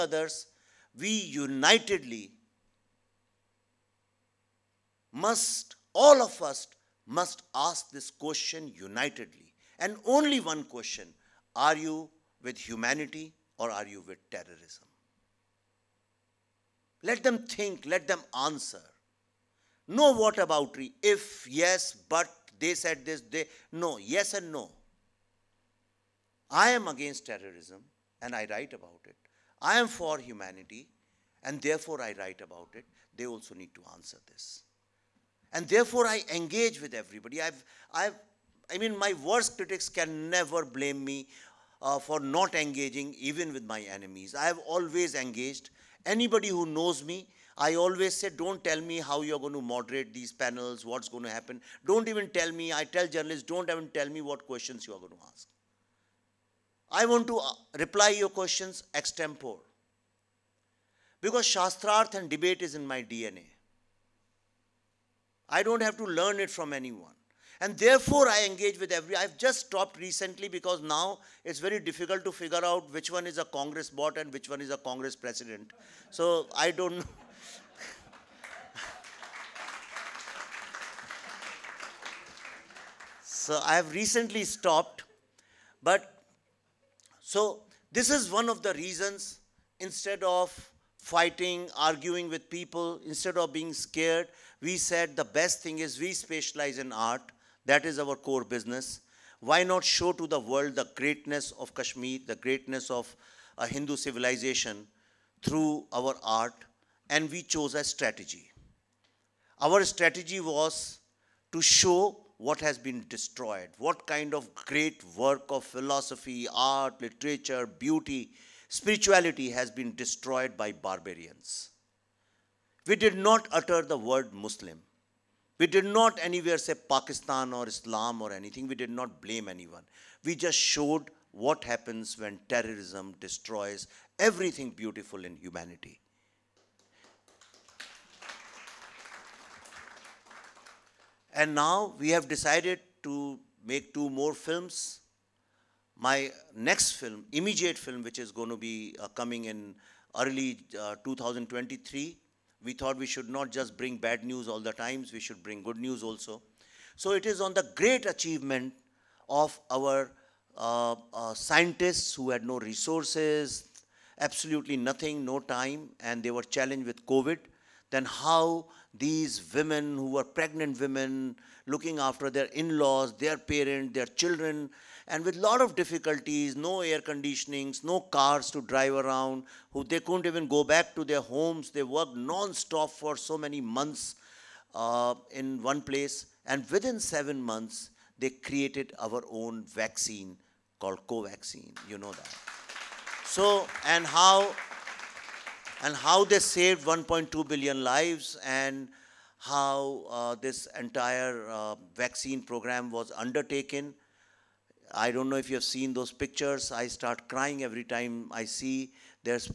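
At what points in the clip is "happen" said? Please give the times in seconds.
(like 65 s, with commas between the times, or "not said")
51 s, 131 s.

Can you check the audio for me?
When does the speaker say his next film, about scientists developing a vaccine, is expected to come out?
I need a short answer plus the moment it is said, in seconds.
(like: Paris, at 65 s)
Early 2023, at 150 s.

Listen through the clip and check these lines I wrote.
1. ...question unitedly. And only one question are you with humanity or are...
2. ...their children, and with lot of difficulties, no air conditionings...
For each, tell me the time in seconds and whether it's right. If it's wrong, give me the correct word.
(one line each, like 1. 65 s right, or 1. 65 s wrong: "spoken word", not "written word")
1. 8 s right
2. 173 s right.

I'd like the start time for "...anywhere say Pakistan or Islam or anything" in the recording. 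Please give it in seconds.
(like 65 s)
126 s.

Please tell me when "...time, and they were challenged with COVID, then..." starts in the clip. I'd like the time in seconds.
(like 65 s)
165 s.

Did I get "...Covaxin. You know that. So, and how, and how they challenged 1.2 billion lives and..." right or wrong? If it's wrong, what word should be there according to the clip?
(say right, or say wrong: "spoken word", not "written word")
wrong: "saved", not "challenged".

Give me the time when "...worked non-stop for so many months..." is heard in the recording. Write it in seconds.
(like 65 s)
181 s.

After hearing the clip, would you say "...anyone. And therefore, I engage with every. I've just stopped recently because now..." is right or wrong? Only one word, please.
right.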